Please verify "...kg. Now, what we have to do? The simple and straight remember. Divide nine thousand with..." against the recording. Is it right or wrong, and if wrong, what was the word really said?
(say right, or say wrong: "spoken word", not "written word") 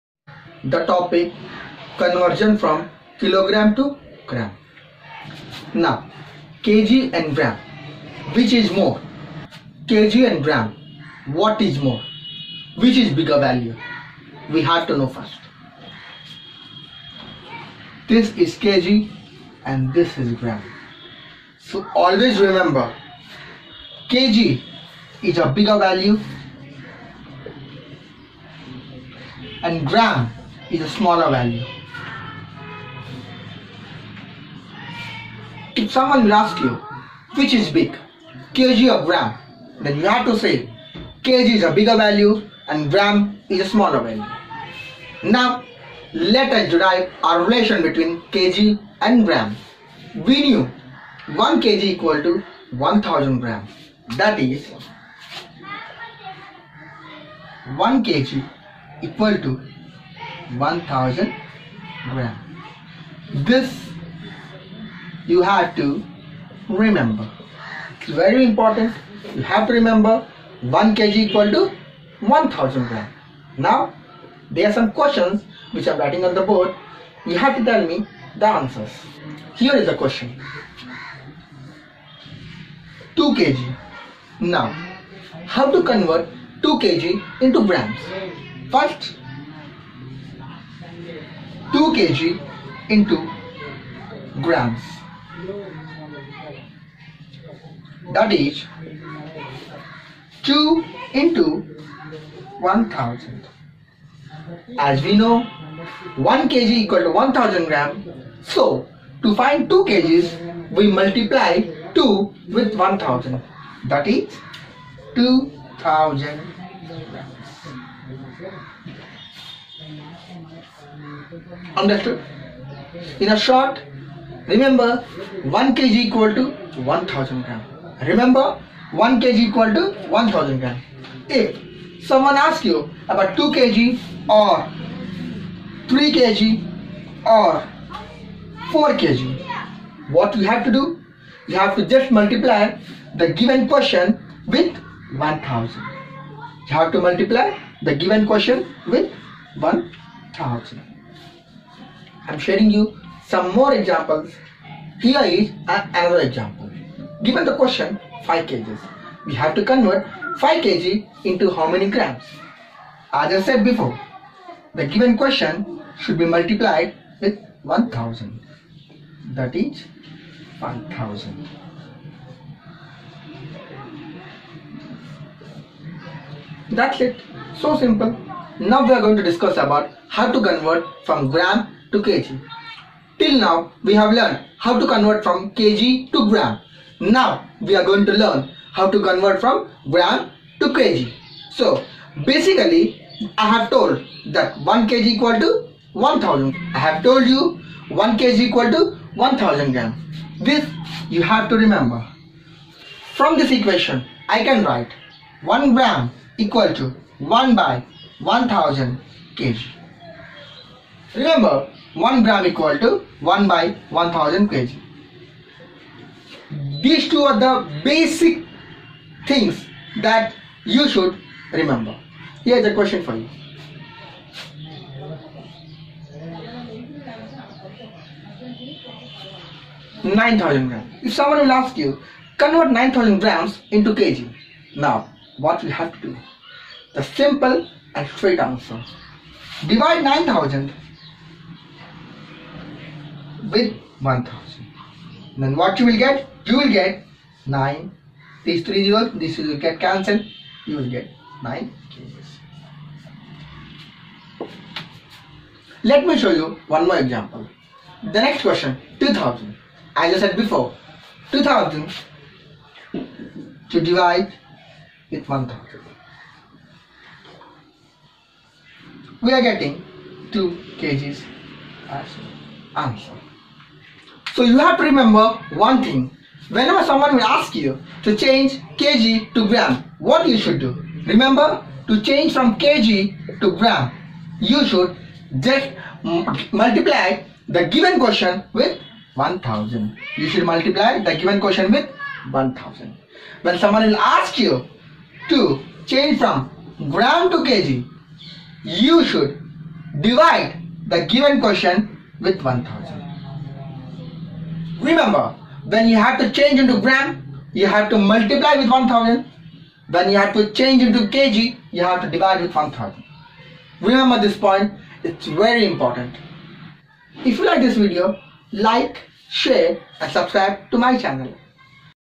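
wrong: "answer", not "remember".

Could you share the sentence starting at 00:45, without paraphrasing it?
Now, let us derive our relation between kg and gram.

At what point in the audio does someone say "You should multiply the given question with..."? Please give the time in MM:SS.
04:50.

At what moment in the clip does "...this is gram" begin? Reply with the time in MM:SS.
00:19.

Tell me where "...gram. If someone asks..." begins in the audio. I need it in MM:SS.
02:10.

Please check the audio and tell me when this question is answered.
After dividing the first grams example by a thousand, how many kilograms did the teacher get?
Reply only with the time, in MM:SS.
04:11.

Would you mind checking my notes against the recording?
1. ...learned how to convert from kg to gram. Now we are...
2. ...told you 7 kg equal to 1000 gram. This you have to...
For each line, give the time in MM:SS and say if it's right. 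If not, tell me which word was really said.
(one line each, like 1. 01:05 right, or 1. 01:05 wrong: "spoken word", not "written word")
1. 03:04 right
2. 03:17 wrong: "1", not "7".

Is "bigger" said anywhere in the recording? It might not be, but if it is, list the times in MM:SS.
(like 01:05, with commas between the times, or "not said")
00:13, 00:25, 00:41.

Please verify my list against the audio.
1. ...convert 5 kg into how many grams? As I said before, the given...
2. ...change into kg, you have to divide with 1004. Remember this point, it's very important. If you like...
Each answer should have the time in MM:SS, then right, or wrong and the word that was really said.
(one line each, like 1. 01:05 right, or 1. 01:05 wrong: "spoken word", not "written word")
1. 02:39 right
2. 05:10 wrong: "1000", not "1004".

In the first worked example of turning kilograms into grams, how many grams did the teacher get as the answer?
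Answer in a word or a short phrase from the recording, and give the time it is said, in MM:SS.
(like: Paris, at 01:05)
2000 grams, at 01:55.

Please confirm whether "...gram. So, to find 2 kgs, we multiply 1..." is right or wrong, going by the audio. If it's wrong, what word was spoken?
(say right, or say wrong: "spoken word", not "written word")
wrong: "2", not "1".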